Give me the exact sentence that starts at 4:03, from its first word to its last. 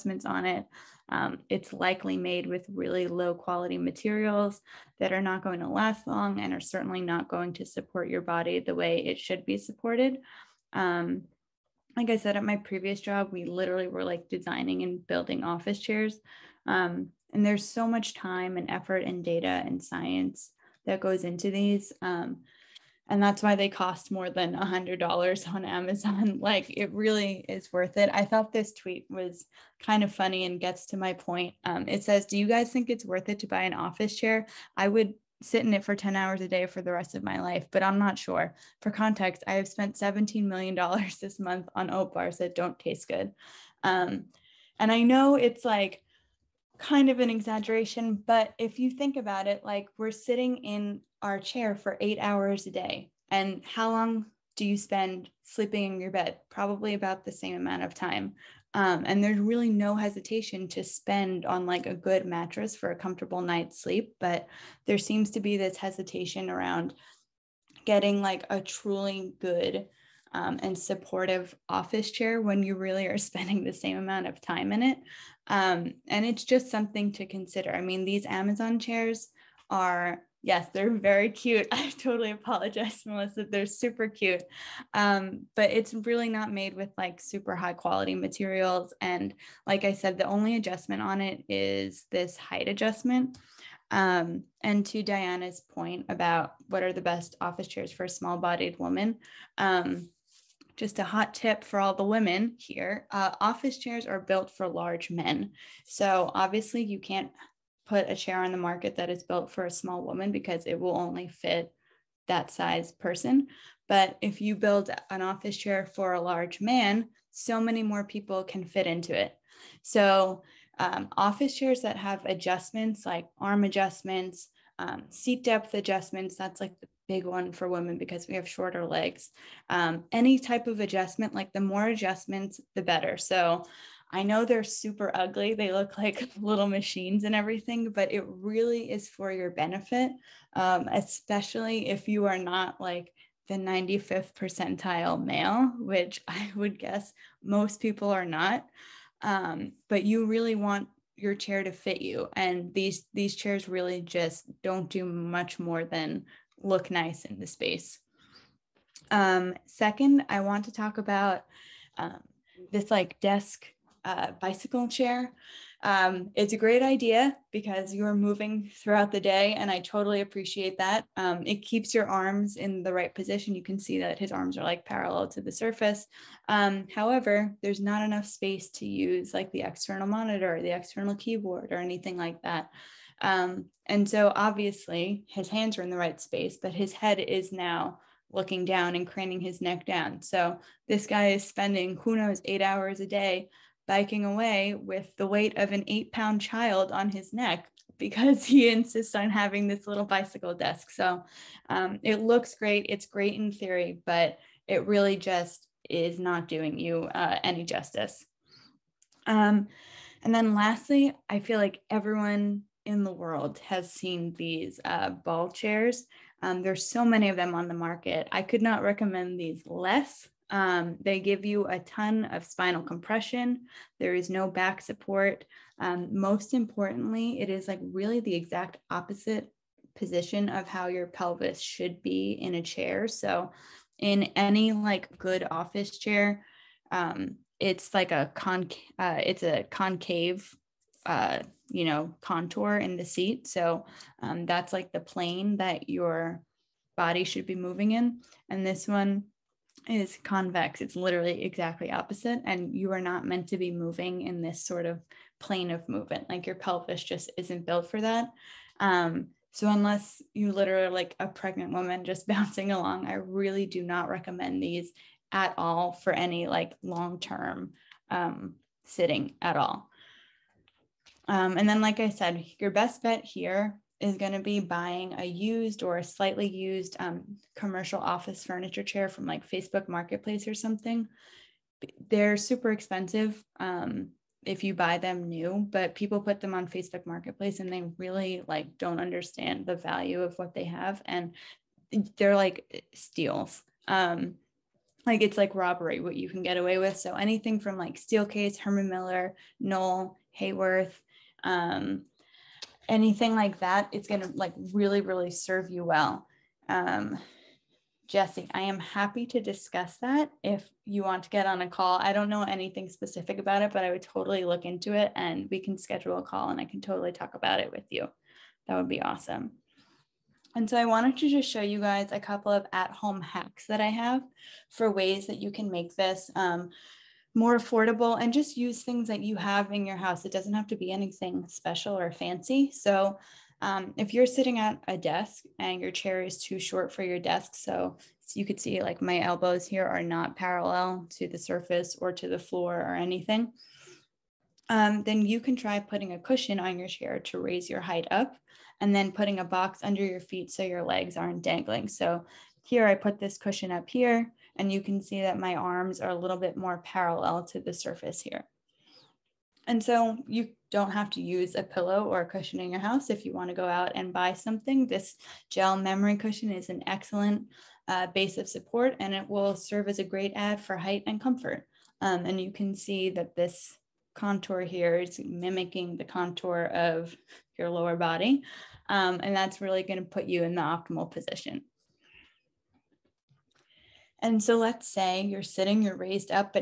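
So um, that's like the plane that your body should be moving in.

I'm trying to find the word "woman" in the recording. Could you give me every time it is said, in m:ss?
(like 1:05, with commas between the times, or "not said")
1:38, 1:50, 4:21.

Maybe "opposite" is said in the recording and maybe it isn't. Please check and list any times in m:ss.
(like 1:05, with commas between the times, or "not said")
3:48, 4:11.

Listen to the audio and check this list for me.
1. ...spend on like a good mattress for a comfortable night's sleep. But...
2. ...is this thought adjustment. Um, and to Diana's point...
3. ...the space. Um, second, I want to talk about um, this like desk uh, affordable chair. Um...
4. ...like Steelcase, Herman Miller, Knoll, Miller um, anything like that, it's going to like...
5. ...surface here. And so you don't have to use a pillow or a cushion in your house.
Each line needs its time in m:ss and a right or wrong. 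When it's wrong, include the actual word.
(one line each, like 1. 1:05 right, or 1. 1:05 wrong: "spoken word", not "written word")
1. 1:00 right
2. 1:31 wrong: "height", not "thought"
3. 2:37 wrong: "bicycle", not "affordable"
4. 4:57 wrong: "Haworth", not "Miller"
5. 5:57 right.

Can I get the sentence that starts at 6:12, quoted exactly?
Um, and you can see that this contour here is mimicking the contour of your lower body.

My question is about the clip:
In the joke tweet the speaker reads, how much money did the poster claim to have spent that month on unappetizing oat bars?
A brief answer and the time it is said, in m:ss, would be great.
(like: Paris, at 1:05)
$17 million, at 0:39.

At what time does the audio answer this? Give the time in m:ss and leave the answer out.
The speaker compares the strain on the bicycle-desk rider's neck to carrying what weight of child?
3:15.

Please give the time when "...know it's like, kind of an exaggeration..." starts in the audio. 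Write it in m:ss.
0:45.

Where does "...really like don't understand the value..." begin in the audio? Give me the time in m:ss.
4:47.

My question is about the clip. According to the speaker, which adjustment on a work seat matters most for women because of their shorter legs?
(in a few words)
seat depth.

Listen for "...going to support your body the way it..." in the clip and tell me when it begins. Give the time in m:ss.
0:07.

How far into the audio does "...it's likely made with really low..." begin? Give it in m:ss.
0:01.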